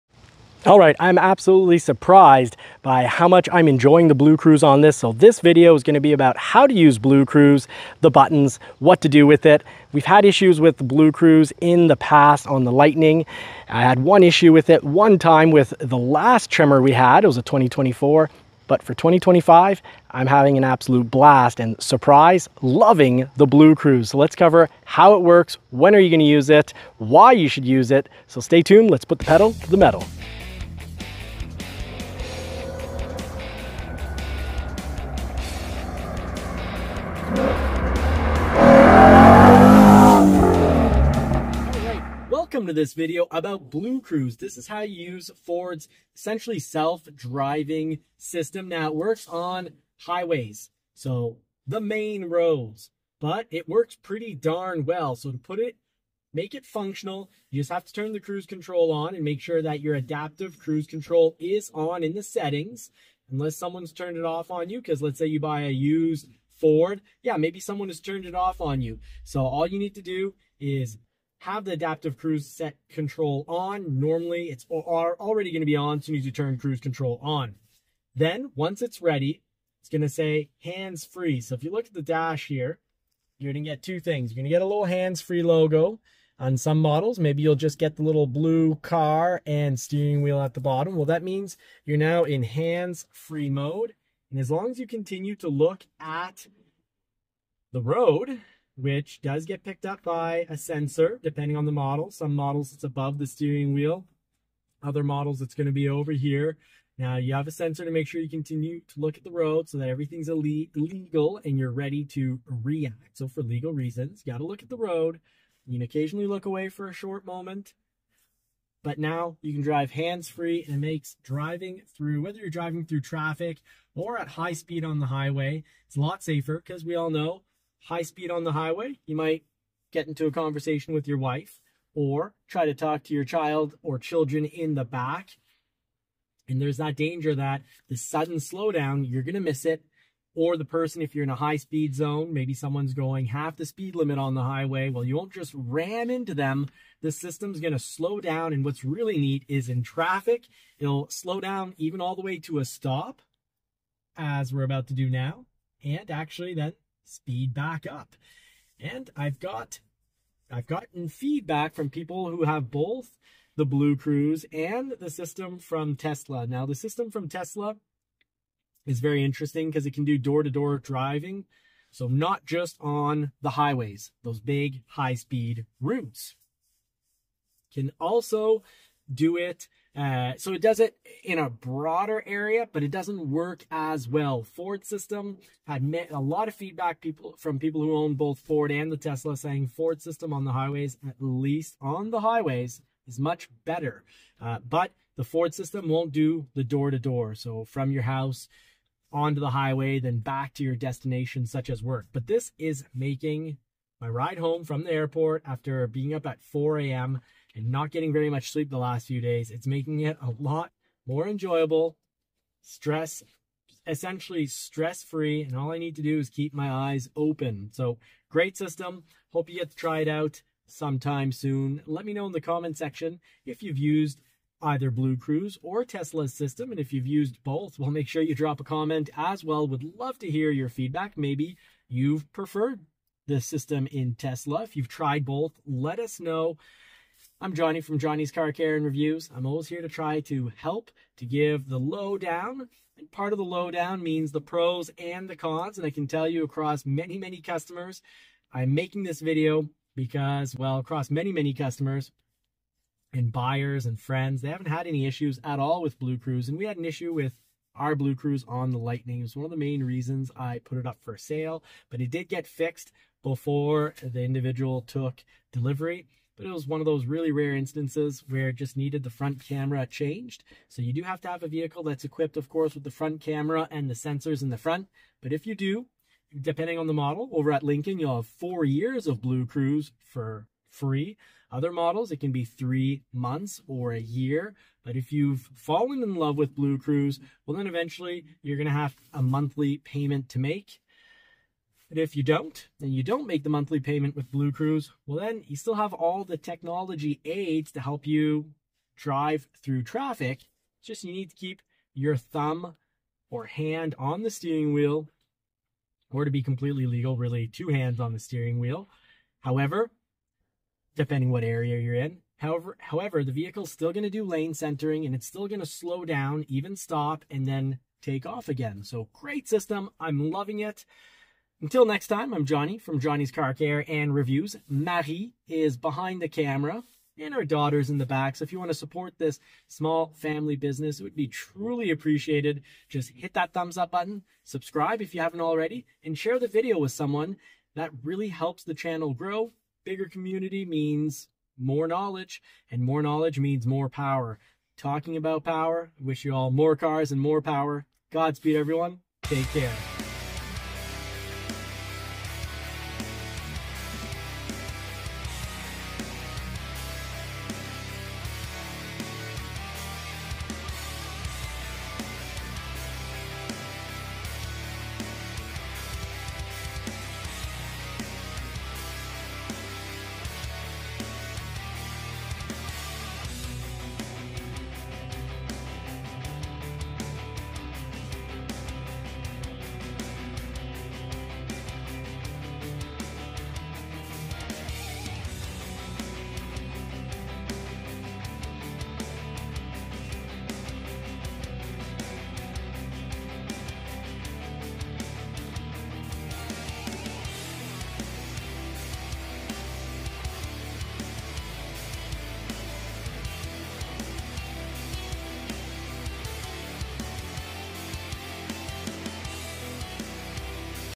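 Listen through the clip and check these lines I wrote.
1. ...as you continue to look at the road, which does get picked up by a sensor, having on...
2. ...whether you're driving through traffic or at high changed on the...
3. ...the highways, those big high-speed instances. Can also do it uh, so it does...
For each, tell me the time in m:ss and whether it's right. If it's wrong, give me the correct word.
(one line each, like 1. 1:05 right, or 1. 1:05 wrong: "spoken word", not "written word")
1. 1:34 wrong: "depending", not "having"
2. 2:02 wrong: "speed", not "changed"
3. 2:53 wrong: "routes", not "instances".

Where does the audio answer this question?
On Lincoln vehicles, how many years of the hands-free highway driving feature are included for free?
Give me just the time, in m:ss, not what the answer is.
4:38.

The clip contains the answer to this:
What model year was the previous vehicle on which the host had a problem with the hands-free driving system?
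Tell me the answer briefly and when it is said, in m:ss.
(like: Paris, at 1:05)
2024, at 0:17.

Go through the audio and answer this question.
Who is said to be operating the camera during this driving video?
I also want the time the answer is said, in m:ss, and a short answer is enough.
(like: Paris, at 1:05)
Marie, at 5:24.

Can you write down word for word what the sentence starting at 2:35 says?
And actually, then speed back up.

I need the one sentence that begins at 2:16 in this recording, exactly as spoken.
And there's that danger that the sudden slowdown, you're going to miss it.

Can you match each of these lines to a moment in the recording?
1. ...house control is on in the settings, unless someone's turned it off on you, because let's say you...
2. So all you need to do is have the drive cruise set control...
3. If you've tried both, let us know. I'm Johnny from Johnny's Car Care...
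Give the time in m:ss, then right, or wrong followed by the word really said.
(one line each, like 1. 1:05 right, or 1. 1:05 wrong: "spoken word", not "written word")
1. 1:00 wrong: "cruise", not "house"
2. 1:09 wrong: "adaptive", not "drive"
3. 3:54 right.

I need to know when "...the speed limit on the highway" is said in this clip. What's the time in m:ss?
2:23.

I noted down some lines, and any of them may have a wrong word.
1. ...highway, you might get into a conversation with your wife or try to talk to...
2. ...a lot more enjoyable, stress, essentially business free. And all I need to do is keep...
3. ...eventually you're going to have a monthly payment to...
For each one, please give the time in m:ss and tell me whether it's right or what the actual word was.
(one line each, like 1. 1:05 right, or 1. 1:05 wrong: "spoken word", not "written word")
1. 2:08 right
2. 3:30 wrong: "stress", not "business"
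3. 4:47 right.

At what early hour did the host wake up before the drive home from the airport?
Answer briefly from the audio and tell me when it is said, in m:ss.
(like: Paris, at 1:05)
4 a.m., at 3:26.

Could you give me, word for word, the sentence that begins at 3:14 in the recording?
Uh, but the Ford system won't do the door to door.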